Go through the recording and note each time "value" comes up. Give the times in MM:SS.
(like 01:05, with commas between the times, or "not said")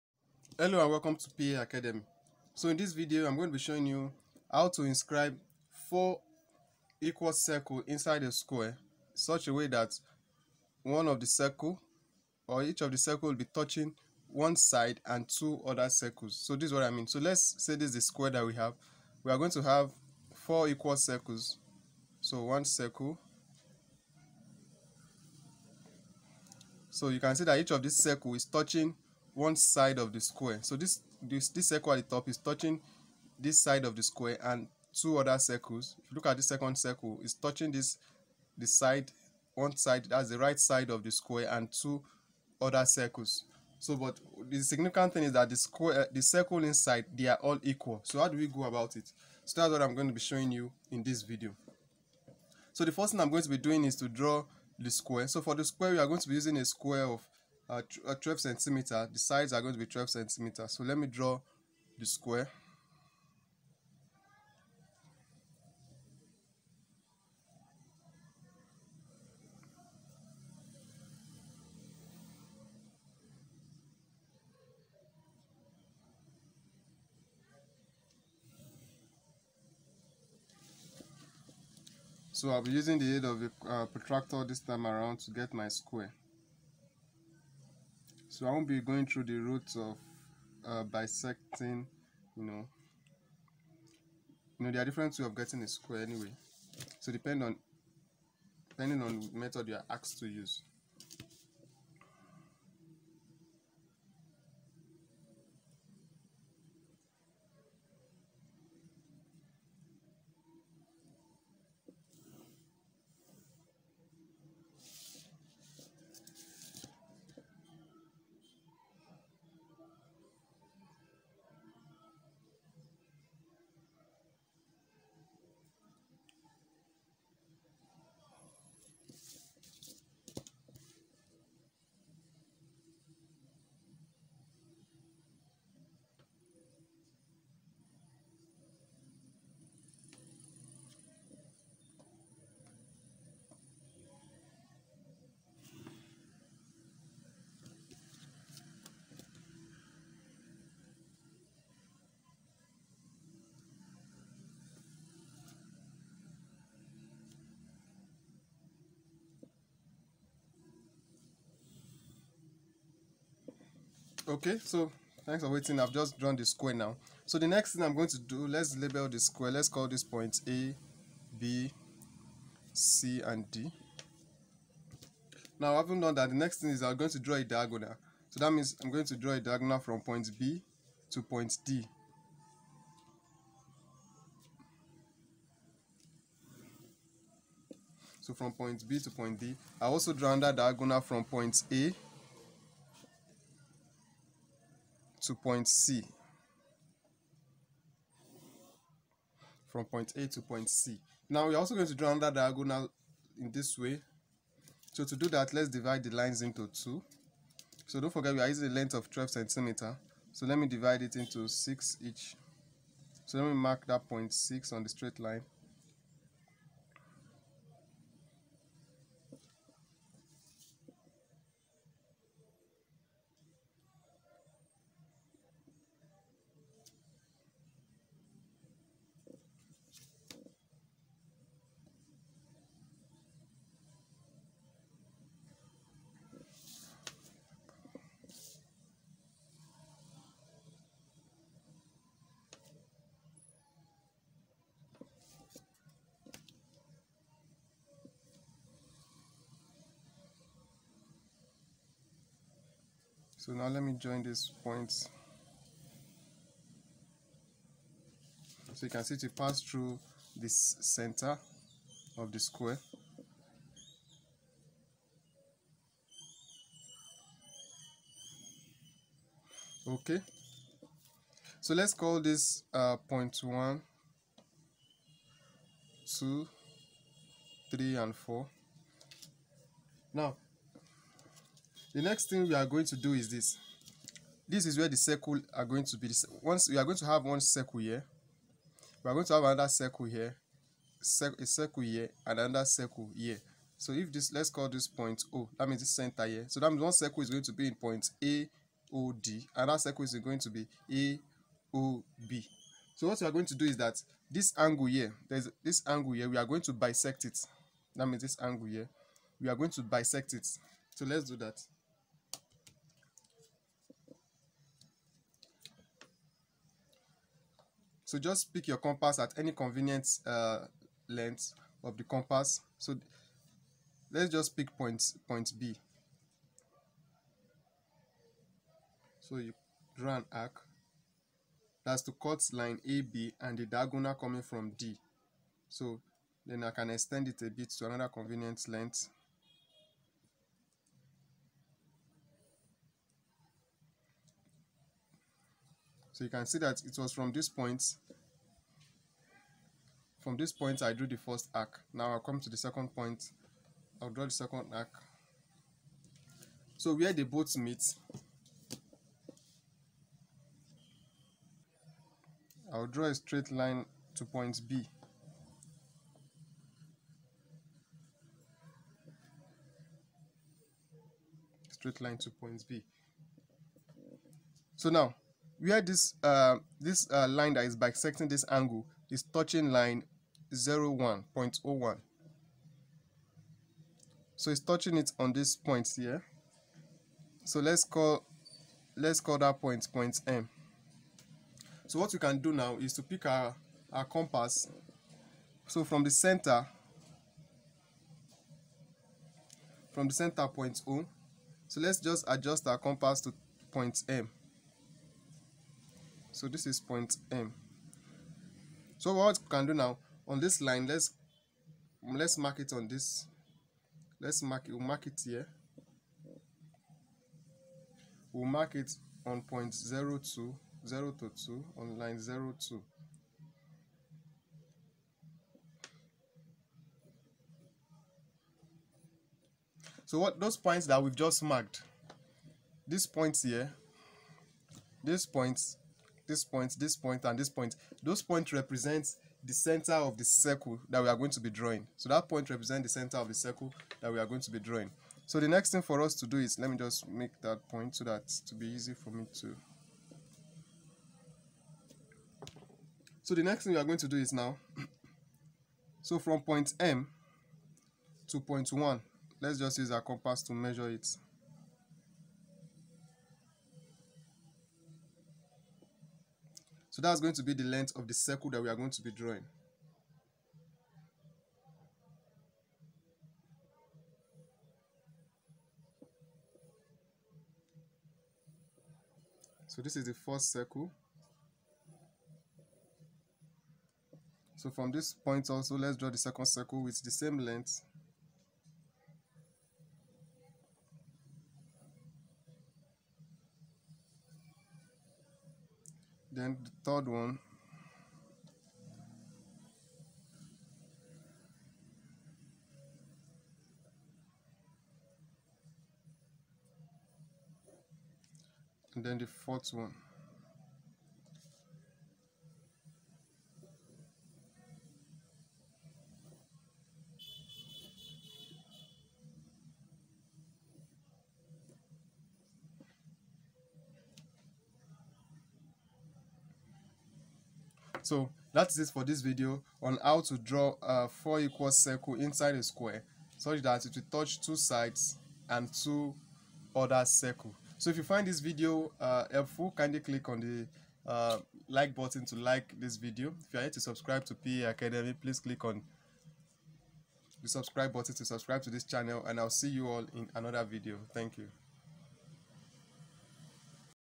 not said.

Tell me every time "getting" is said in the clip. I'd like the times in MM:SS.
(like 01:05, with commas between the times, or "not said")
01:35.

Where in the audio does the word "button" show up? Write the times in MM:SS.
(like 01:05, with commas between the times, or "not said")
09:01, 09:07.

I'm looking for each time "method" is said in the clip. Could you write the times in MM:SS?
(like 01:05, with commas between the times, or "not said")
01:39.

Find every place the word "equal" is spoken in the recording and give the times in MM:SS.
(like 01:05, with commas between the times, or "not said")
00:06, 00:20, 00:47, 08:51.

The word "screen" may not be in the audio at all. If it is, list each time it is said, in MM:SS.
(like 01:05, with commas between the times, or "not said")
not said.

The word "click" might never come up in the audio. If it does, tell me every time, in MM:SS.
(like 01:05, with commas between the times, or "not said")
09:00, 09:05.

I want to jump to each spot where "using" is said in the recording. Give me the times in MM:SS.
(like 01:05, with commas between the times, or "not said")
00:56, 01:22, 03:28.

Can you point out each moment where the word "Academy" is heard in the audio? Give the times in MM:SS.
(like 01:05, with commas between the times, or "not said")
00:01, 09:04.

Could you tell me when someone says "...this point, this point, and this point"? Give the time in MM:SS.
07:16.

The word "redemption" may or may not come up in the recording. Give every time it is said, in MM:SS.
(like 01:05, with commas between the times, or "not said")
not said.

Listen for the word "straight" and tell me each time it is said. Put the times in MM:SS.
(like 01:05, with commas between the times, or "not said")
03:34, 06:03, 06:11.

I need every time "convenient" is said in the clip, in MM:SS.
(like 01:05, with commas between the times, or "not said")
05:19, 05:38.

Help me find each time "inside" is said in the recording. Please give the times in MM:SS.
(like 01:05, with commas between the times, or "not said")
00:07, 00:46, 08:52.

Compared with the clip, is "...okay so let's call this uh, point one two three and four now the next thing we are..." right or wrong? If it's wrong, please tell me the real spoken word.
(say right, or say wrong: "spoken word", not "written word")
right.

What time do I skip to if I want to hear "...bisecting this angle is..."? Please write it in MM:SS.
06:17.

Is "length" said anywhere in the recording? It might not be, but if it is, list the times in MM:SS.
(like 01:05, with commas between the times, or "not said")
03:28, 05:21, 05:38, 07:47, 08:07.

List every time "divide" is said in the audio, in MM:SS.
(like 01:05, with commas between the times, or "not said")
03:25, 03:30.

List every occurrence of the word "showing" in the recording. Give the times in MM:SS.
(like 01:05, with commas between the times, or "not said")
00:03, 00:50.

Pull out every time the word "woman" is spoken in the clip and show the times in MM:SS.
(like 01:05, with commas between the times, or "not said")
not said.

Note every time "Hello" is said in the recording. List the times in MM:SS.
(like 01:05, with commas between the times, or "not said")
00:00.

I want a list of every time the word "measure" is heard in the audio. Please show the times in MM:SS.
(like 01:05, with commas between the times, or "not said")
07:40.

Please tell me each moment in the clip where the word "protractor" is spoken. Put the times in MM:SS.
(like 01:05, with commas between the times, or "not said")
01:23.